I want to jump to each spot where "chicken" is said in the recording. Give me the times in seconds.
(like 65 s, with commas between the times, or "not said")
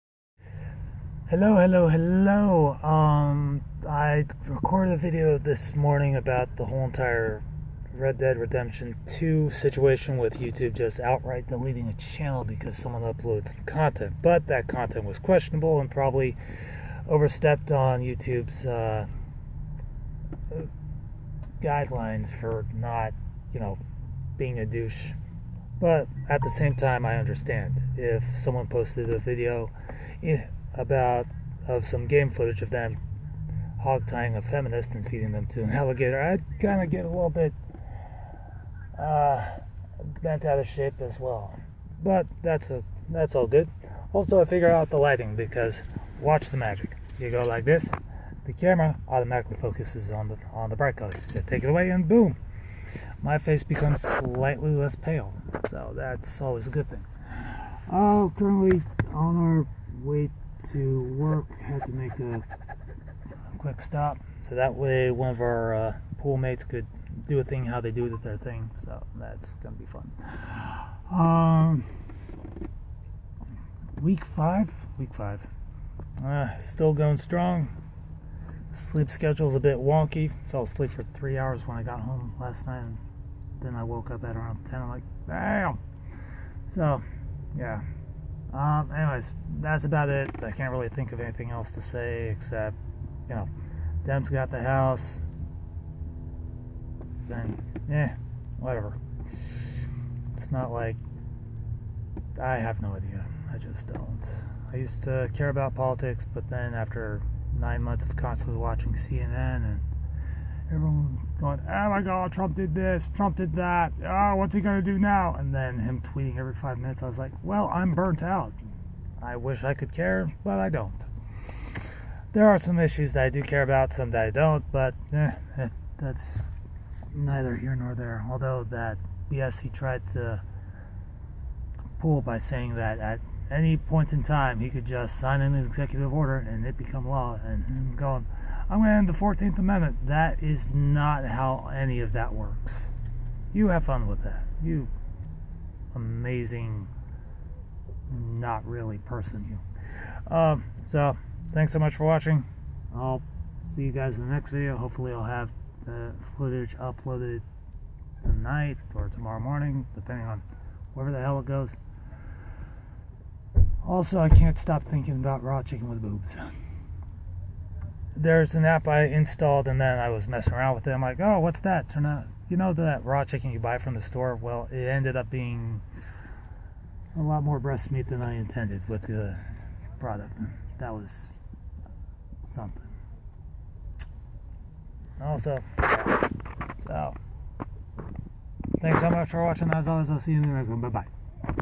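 165 s, 173 s.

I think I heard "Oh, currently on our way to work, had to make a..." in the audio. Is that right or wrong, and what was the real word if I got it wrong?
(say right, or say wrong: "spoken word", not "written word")
right.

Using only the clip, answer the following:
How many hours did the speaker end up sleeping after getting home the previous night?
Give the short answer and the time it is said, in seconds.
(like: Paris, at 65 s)
3, at 81 s.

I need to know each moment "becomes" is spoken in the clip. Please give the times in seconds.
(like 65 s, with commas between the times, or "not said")
53 s, 136 s.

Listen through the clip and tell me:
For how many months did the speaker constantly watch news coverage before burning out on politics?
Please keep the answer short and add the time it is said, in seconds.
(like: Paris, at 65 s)
9, at 107 s.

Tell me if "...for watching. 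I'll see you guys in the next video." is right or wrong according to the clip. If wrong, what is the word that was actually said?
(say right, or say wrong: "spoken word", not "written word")
right.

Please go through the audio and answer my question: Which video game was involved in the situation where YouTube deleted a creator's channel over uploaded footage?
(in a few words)
Red Dead Redemption 2.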